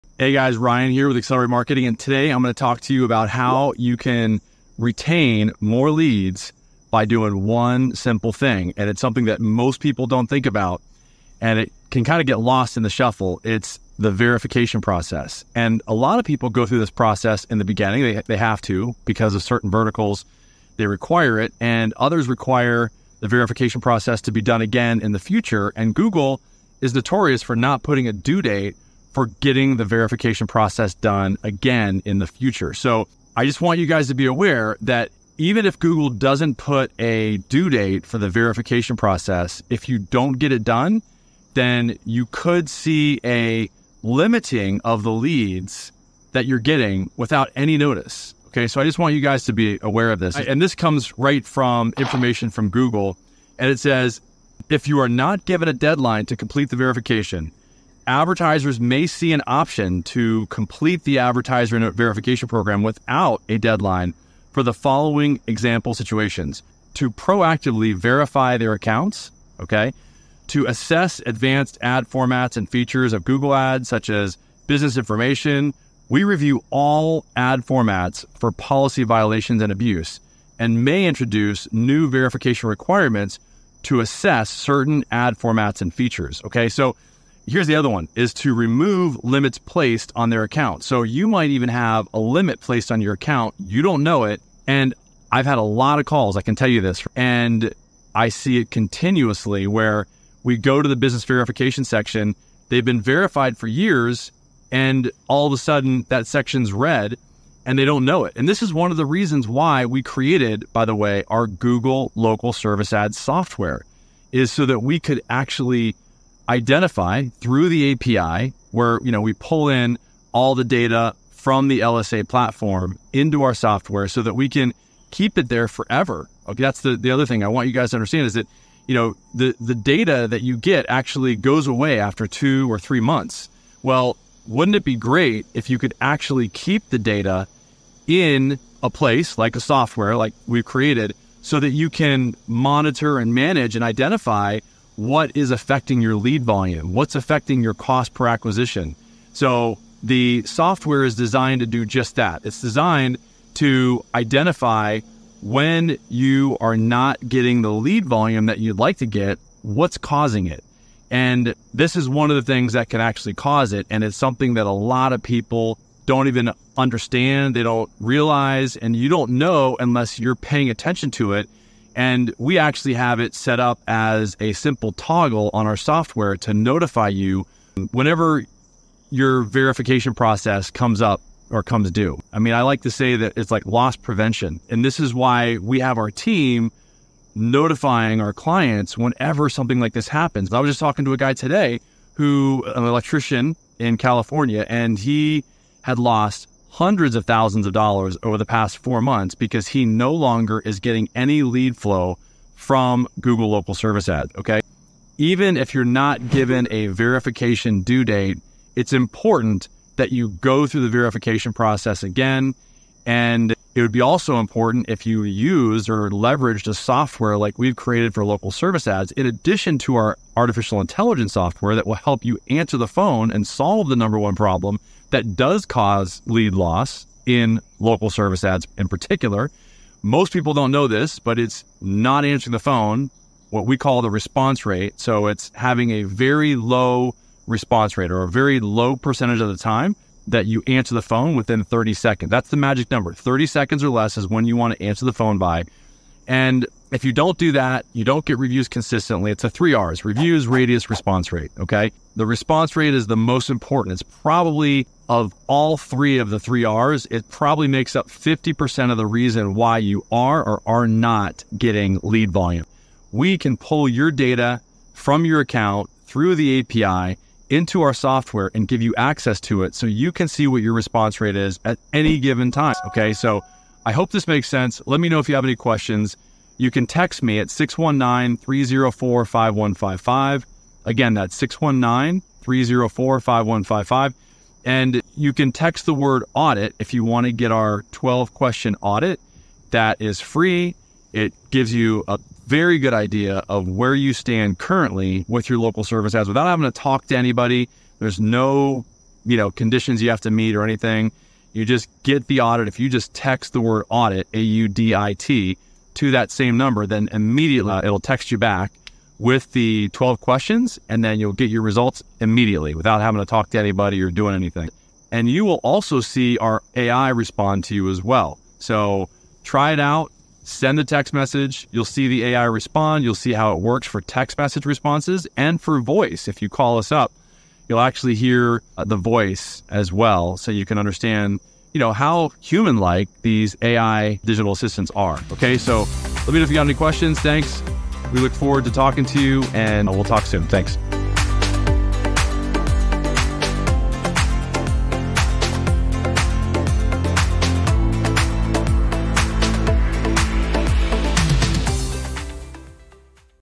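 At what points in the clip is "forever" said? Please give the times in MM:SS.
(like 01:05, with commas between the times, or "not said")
02:05.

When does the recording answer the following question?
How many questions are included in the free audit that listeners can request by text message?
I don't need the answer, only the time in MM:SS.
04:47.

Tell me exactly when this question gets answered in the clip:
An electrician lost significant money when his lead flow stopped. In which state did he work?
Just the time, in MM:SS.
03:13.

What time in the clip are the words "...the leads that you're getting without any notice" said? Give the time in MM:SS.
00:45.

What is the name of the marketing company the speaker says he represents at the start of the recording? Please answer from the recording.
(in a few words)
Accelerate Marketing.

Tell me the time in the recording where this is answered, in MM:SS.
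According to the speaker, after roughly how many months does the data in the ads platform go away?
02:12.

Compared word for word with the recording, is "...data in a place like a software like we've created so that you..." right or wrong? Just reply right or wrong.
right.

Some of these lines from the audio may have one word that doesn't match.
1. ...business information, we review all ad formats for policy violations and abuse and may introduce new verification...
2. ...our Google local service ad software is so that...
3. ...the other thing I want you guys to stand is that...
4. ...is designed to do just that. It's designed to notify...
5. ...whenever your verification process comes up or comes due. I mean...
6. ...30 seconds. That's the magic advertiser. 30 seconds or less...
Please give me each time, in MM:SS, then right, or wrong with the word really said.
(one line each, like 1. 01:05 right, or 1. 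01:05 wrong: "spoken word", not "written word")
1. 01:14 right
2. 01:51 right
3. 02:06 wrong: "understand", not "stand"
4. 02:31 wrong: "identify", not "notify"
5. 02:57 right
6. 04:01 wrong: "number", not "advertiser".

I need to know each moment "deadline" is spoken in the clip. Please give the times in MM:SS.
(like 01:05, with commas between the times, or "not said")
00:55, 01:03.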